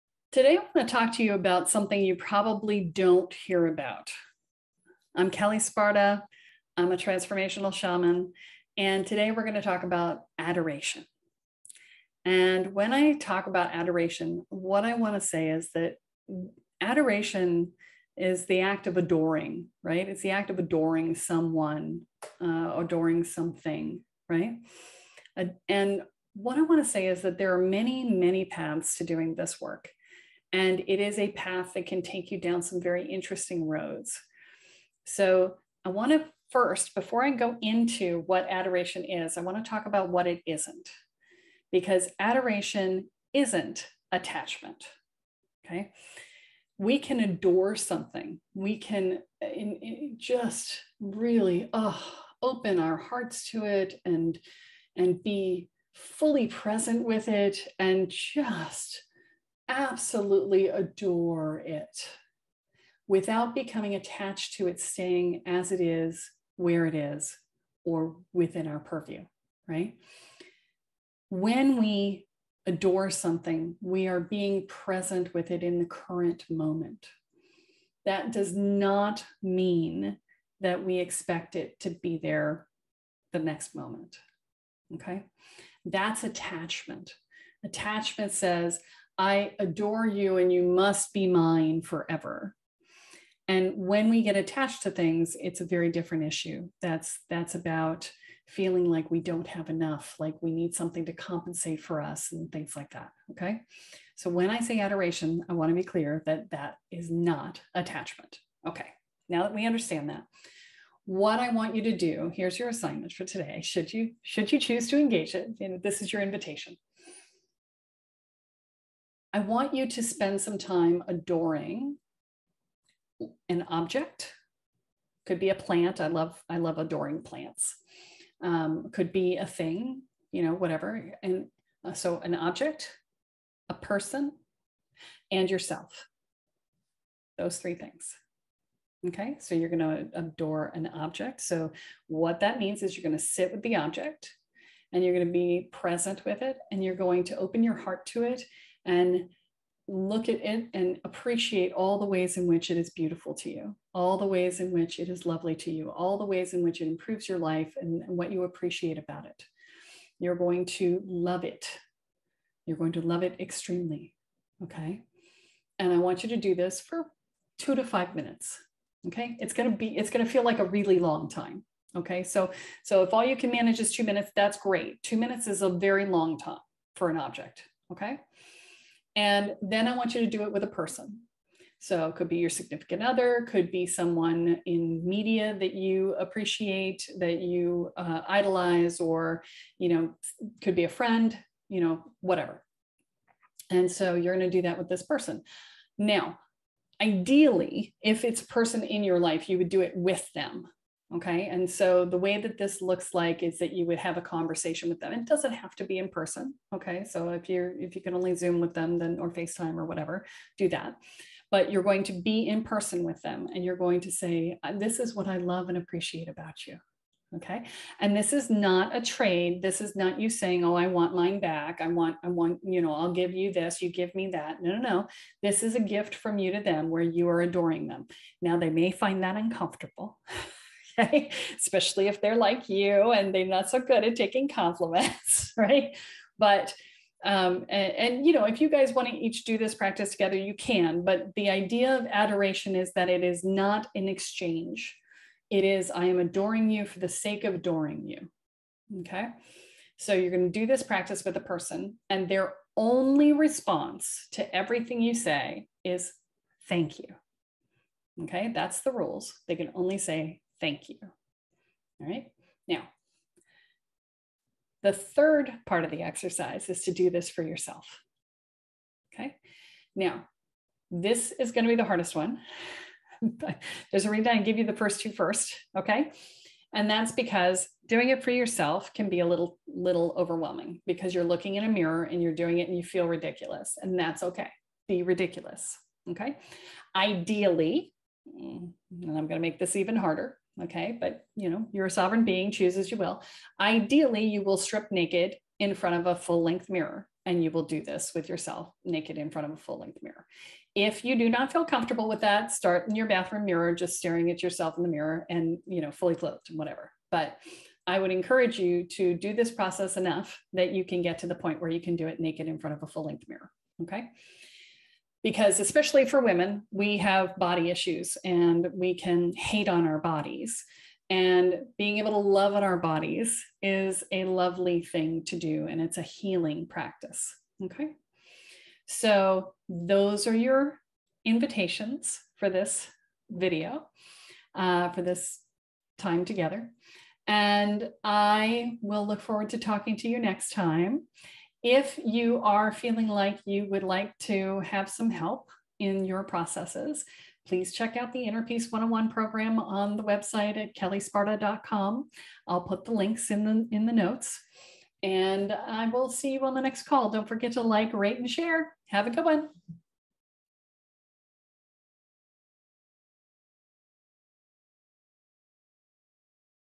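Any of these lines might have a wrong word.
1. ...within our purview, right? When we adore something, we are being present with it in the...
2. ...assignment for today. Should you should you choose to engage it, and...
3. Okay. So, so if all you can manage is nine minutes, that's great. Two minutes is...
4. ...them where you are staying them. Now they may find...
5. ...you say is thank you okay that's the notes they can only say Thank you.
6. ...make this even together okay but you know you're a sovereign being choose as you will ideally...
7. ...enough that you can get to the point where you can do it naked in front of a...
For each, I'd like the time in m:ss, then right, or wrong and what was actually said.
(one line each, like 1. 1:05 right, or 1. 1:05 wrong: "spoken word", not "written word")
1. 1:08 right
2. 1:52 right
3. 2:51 wrong: "two", not "nine"
4. 3:46 wrong: "adoring", not "staying"
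5. 4:14 wrong: "rules", not "notes"
6. 4:49 wrong: "harder", not "together"
7. 5:09 right.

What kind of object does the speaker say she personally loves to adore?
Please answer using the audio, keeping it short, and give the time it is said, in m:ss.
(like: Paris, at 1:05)
plants, at 2:06.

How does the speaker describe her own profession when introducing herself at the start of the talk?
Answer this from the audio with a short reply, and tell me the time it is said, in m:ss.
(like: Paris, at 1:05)
transformational shaman, at 0:06.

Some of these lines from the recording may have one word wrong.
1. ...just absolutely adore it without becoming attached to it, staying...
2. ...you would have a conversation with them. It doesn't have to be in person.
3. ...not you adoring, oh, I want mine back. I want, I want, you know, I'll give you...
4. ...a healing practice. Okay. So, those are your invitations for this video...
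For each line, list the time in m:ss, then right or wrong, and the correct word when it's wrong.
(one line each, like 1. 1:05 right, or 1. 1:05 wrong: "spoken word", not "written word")
1. 0:58 right
2. 3:23 right
3. 3:39 wrong: "saying", not "adoring"
4. 5:25 right.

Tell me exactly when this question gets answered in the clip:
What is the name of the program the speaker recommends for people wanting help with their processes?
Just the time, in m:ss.
5:48.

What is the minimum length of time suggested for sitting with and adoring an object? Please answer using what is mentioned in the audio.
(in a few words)
2 minutes.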